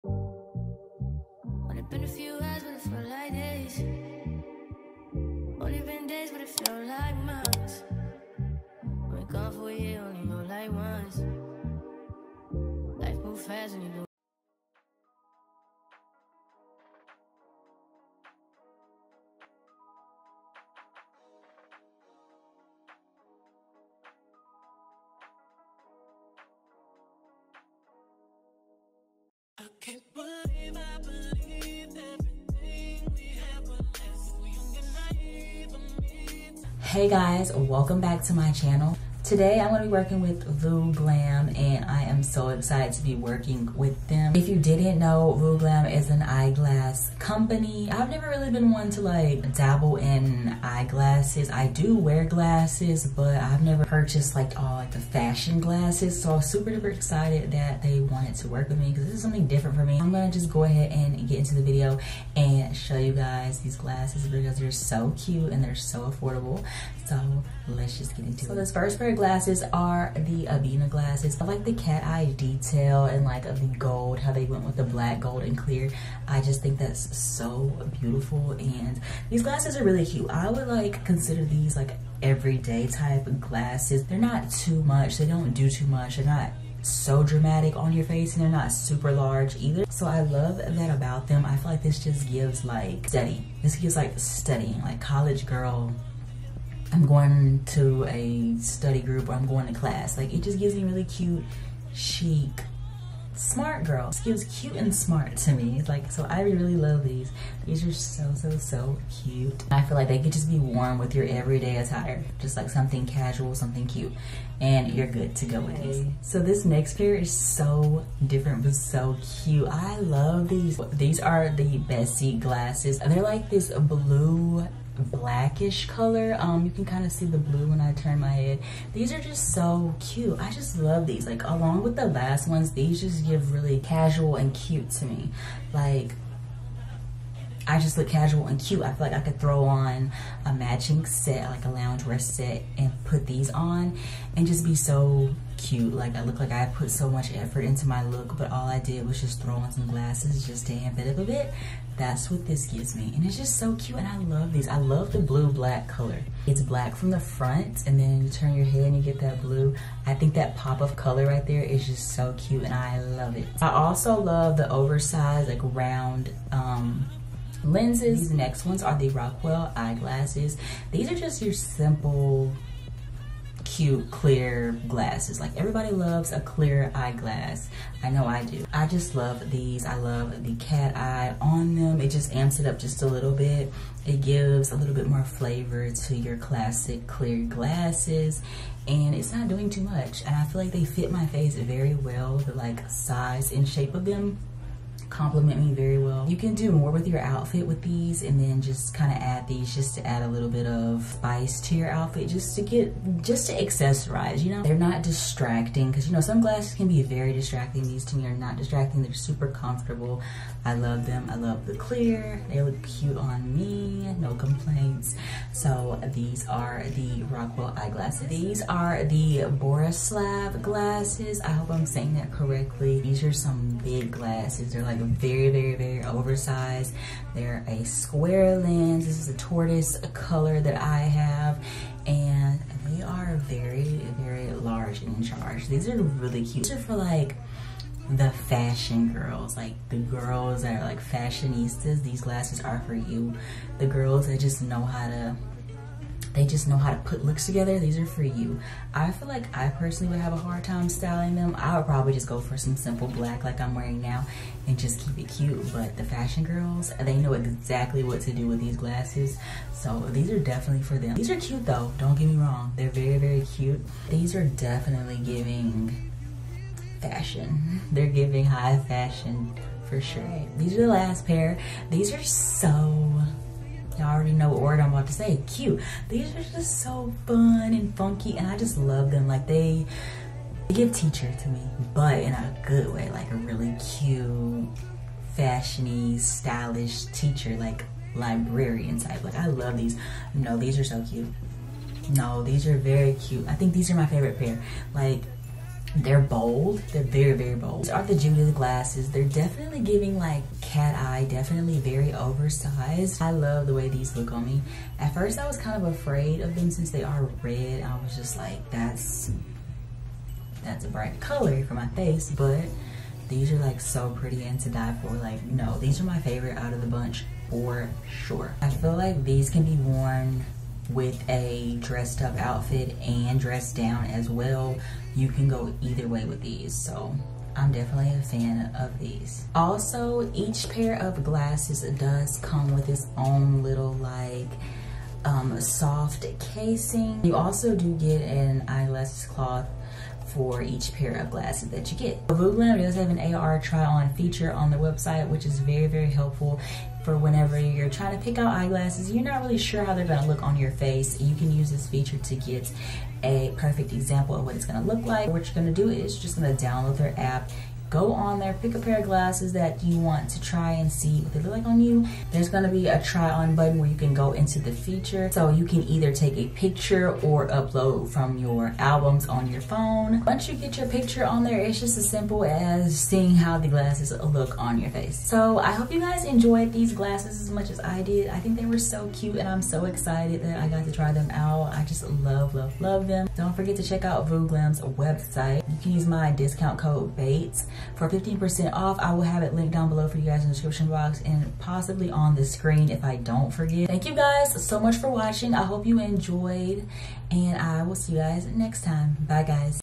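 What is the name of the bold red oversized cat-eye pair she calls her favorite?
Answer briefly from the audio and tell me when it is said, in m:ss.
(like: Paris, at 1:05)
Judith, at 4:58.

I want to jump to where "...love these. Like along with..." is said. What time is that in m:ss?
2:10.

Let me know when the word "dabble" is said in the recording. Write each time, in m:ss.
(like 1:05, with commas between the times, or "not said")
0:49.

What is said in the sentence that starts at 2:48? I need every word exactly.
These next ones are the Raquel eyeglasses.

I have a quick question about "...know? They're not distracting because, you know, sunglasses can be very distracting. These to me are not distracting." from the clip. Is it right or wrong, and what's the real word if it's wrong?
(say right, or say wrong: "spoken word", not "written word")
right.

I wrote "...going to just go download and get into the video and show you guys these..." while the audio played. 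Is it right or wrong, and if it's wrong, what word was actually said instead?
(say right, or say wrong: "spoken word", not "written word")
wrong: "ahead", not "download".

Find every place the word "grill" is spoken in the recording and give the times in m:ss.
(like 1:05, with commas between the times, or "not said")
not said.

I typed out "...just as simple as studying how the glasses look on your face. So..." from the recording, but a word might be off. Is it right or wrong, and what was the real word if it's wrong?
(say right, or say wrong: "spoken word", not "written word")
wrong: "seeing", not "studying".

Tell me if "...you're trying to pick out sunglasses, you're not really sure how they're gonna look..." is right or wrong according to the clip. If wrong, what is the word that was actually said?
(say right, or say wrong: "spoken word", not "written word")
wrong: "eyeglasses", not "sunglasses".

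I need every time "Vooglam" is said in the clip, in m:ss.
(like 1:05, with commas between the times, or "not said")
0:40, 0:45, 6:24.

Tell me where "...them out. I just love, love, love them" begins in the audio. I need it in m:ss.
6:21.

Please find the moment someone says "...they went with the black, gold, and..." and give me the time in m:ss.
1:14.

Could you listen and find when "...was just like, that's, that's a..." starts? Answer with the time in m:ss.
5:08.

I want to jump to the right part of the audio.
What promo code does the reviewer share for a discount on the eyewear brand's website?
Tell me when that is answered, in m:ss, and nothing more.
6:27.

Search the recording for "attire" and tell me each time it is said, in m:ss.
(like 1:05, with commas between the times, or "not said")
1:51.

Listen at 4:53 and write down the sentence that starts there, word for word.
I think these are my favorite pair.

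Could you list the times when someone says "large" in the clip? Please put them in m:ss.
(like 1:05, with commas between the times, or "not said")
1:29, 3:54.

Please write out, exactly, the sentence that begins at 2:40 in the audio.
I think that pop of color right there is just so cute and I love it.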